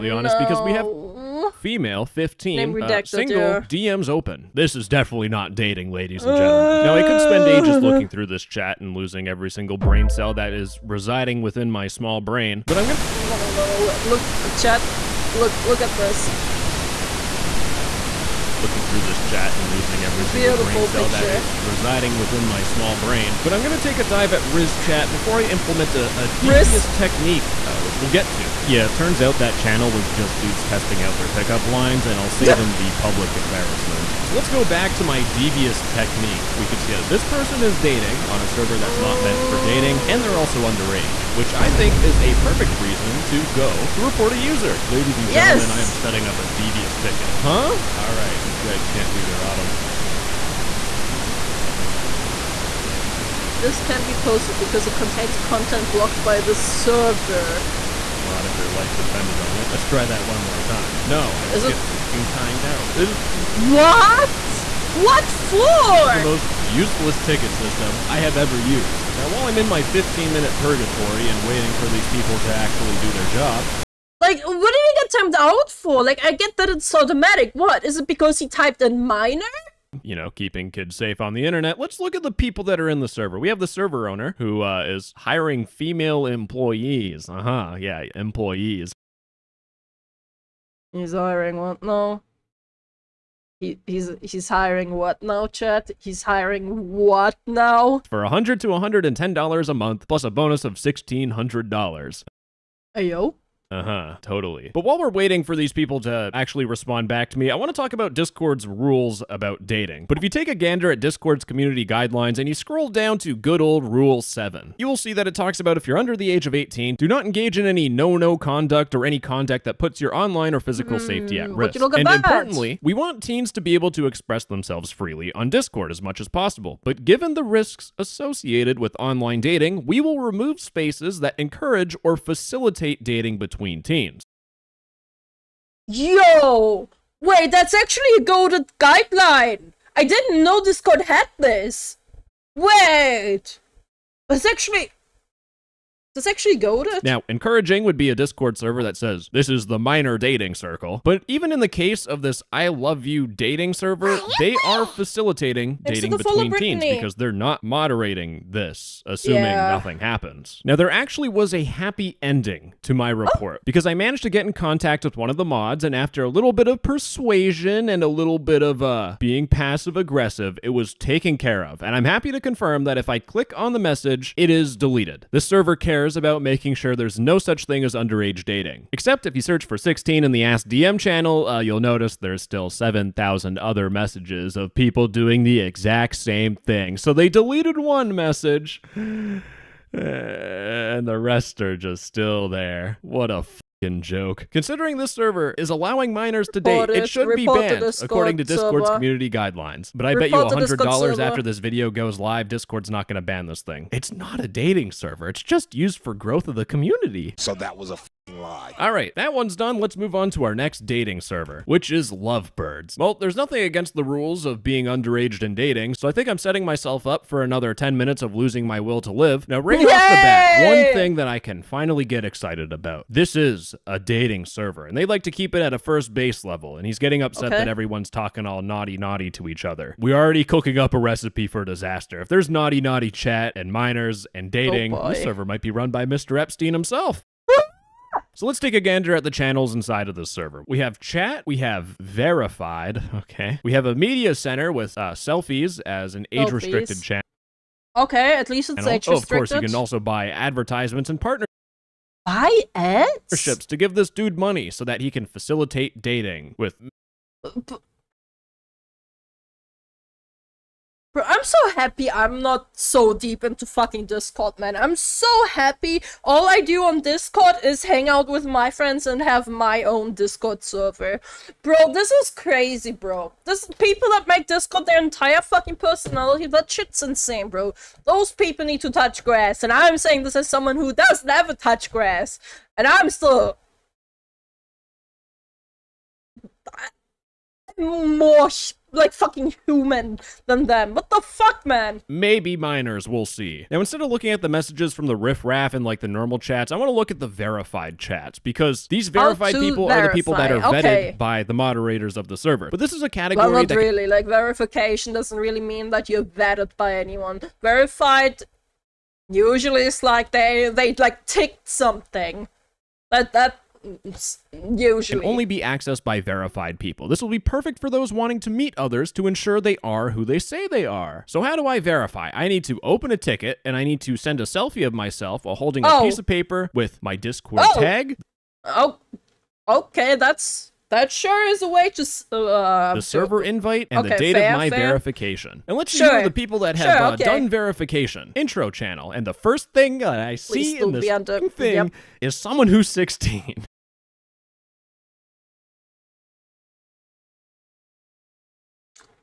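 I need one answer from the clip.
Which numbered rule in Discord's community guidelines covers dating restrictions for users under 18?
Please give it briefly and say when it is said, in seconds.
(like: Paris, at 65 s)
Rule 7, at 113 s.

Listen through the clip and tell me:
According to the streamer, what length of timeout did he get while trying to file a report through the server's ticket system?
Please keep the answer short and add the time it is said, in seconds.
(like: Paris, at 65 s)
15 minutes, at 69 s.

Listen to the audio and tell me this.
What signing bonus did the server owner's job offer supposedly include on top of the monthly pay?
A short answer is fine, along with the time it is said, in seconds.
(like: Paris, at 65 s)
$1,600, at 100 s.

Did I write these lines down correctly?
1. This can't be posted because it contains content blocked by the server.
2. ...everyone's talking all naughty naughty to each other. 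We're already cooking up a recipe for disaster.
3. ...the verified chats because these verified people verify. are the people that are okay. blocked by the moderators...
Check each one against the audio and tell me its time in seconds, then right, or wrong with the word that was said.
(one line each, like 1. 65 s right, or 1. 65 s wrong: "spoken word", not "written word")
1. 53 s right
2. 227 s right
3. 297 s wrong: "vetted", not "blocked".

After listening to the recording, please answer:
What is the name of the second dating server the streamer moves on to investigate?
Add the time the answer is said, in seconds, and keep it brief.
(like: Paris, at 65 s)
Lovebirds, at 212 s.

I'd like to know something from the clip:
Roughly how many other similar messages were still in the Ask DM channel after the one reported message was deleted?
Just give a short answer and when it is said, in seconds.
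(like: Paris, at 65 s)
7,000, at 182 s.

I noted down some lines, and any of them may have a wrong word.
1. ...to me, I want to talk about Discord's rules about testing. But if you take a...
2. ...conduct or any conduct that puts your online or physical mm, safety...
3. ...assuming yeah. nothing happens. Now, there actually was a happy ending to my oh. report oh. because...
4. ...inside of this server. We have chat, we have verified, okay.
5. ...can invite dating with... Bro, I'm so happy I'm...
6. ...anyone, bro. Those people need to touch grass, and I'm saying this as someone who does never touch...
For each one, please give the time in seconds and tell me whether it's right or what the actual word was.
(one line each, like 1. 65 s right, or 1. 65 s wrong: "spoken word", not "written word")
1. 107 s wrong: "dating", not "testing"
2. 118 s right
3. 159 s right
4. 239 s right
5. 255 s wrong: "facilitate", not "invite"
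6. 277 s wrong: "insane", not "anyone".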